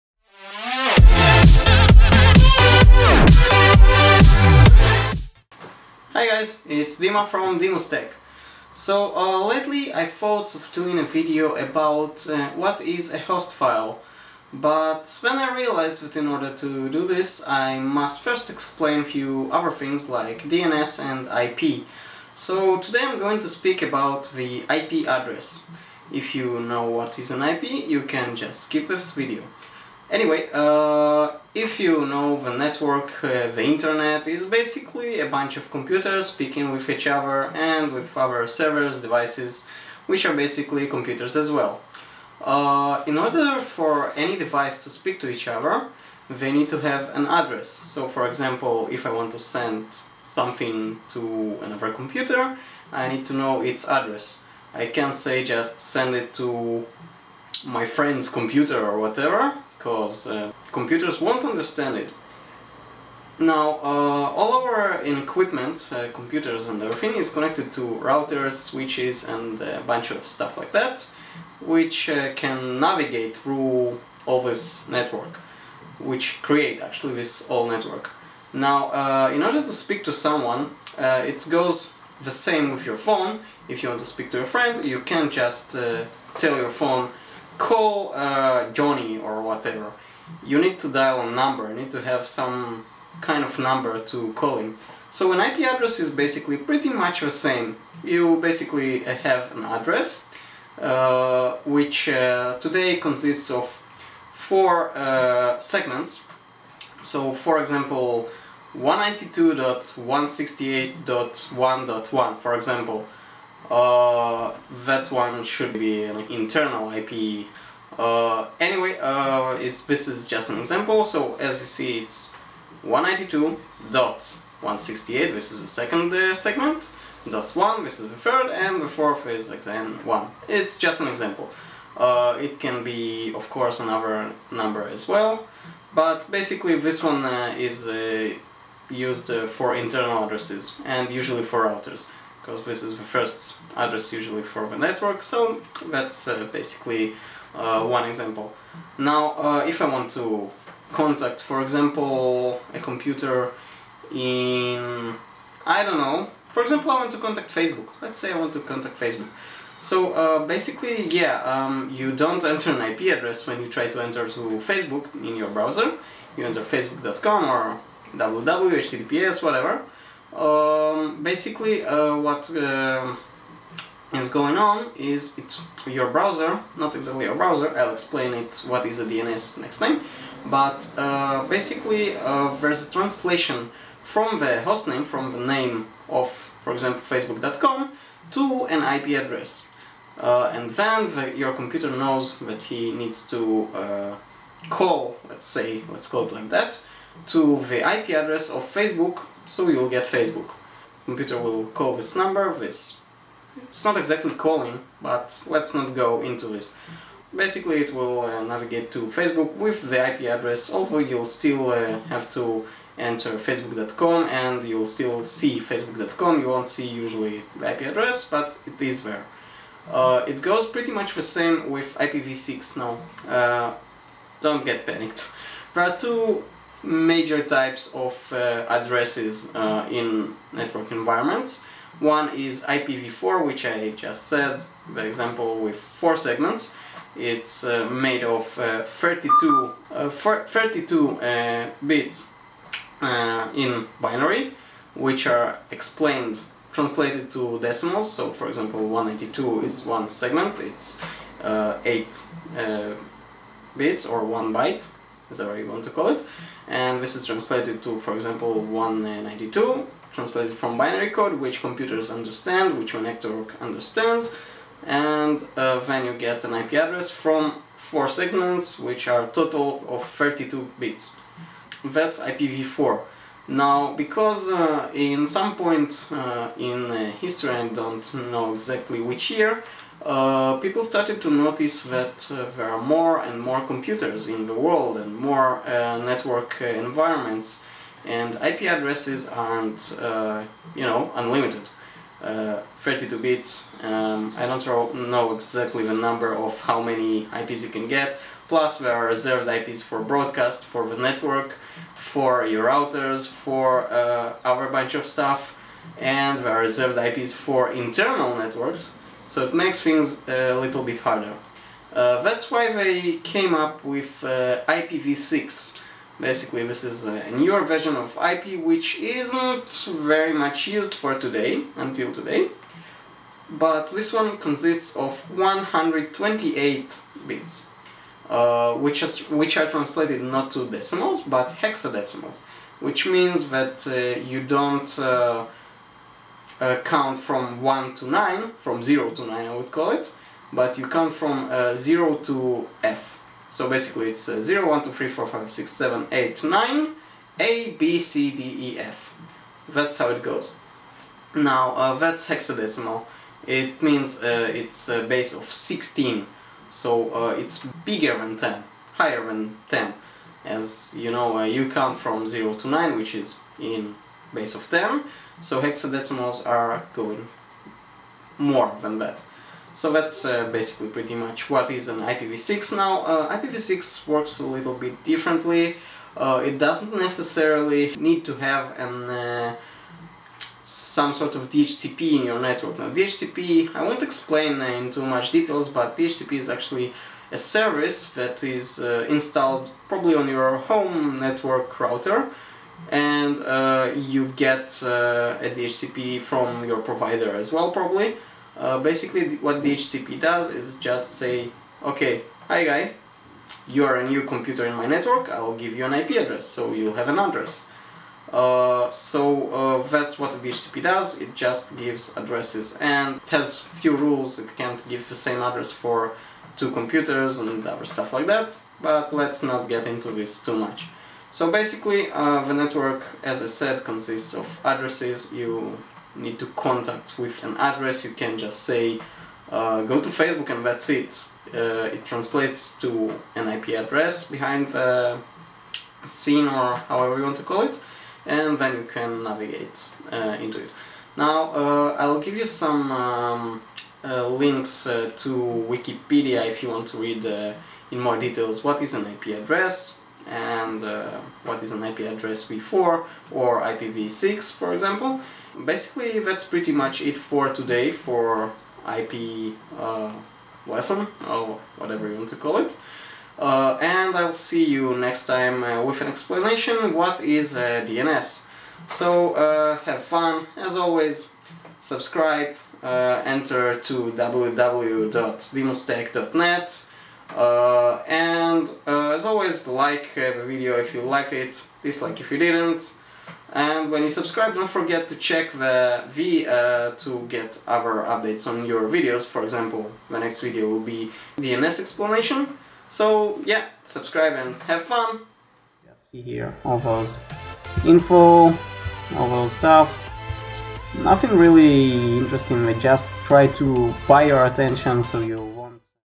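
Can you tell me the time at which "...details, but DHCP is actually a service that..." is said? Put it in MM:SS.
06:25.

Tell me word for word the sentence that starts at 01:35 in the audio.
So an IP address is basically pretty much the same.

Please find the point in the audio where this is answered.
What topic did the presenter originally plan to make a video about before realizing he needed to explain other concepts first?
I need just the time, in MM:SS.
00:13.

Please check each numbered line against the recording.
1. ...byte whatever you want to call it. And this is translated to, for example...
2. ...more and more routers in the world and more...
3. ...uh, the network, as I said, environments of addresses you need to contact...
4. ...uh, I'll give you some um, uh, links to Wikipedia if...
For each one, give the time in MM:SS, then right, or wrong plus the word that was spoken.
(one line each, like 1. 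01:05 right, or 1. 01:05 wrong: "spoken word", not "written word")
1. 04:14 right
2. 04:42 wrong: "computers", not "routers"
3. 07:02 wrong: "consists", not "environments"
4. 07:21 right.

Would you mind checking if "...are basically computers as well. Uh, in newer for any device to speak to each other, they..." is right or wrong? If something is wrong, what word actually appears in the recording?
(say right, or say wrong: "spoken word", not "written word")
wrong: "order", not "newer".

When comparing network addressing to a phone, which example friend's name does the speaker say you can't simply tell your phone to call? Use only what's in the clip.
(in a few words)
Johnny.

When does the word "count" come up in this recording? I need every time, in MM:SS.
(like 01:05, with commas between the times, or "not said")
05:36, 05:40, 06:01.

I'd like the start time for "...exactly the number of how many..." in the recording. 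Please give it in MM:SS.
04:55.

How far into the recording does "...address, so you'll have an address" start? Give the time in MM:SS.
06:46.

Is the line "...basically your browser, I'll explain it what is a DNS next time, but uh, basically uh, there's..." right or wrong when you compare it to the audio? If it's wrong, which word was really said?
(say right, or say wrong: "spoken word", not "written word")
wrong: "exactly", not "basically".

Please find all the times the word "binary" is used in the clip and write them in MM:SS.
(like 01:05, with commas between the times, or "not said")
04:03, 04:20.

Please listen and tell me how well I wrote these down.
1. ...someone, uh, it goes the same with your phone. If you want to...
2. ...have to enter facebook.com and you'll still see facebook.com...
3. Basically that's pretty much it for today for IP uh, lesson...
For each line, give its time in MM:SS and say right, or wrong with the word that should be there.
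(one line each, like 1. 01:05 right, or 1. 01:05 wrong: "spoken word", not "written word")
1. 01:20 right
2. 03:32 right
3. 07:35 right.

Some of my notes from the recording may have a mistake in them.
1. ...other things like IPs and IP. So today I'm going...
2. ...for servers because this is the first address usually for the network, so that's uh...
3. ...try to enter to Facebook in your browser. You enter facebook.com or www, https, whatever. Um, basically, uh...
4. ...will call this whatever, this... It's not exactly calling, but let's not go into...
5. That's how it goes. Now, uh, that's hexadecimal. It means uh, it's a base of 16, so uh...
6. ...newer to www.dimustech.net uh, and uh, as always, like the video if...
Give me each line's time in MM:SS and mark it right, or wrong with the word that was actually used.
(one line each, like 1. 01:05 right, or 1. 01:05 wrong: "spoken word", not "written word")
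1. 00:19 wrong: "DNS", not "IPs"
2. 02:21 wrong: "routers", not "servers"
3. 02:43 right
4. 03:21 wrong: "number", not "whatever"
5. 05:49 right
6. 07:52 wrong: "enter", not "newer".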